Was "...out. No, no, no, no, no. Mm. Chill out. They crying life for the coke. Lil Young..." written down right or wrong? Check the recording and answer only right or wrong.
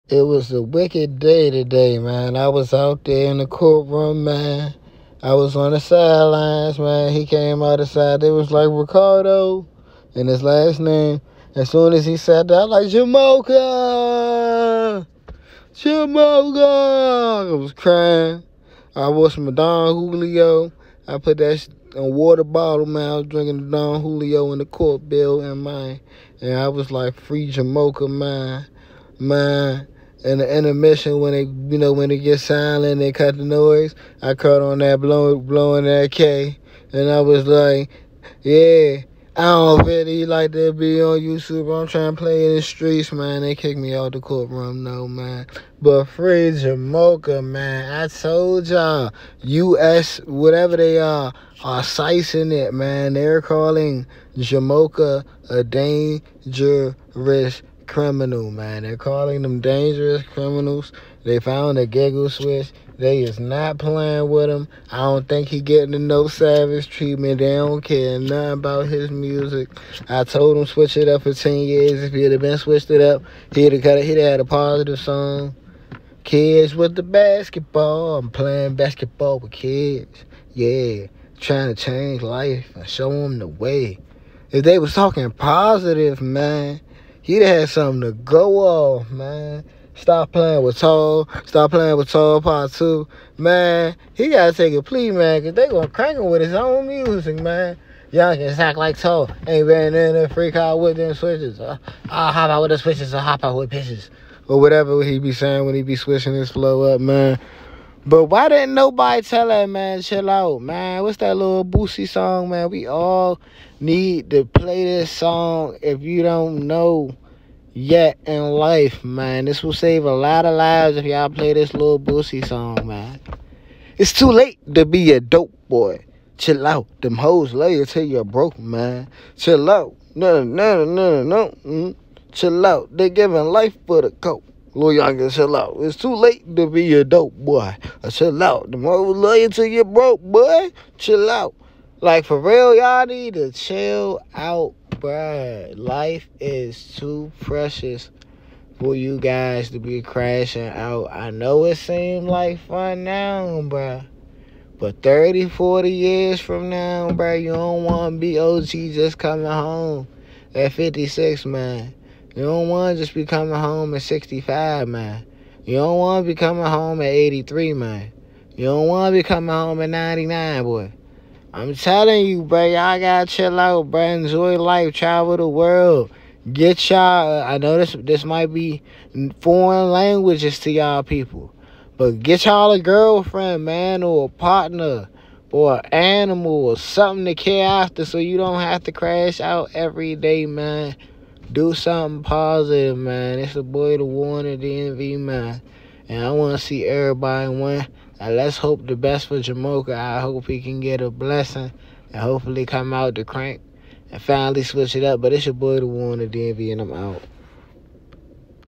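wrong.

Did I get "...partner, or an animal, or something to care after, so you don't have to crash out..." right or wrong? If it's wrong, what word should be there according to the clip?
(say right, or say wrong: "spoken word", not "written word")
right.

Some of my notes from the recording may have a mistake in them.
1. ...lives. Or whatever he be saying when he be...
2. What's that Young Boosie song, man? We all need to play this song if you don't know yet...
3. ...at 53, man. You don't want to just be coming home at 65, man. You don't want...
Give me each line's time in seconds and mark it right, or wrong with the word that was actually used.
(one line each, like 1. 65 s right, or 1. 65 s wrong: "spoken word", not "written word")
1. 103 s wrong: "pitches", not "lives"
2. 111 s wrong: "Lil", not "Young"
3. 160 s wrong: "56", not "53".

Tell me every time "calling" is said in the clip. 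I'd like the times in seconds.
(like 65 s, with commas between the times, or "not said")
53 s, 58 s.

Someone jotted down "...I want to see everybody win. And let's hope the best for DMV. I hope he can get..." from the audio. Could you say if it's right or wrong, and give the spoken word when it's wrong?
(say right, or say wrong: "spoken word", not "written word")
wrong: "Jamoka", not "DMV".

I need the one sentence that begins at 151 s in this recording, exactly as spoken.
I know it seems like fun now, bruh.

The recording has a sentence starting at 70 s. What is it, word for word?
I told him switch it up for 10 years.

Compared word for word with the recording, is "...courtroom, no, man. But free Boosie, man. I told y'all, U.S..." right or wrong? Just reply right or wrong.
wrong.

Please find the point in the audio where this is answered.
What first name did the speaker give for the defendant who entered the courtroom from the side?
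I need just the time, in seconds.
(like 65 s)
8 s.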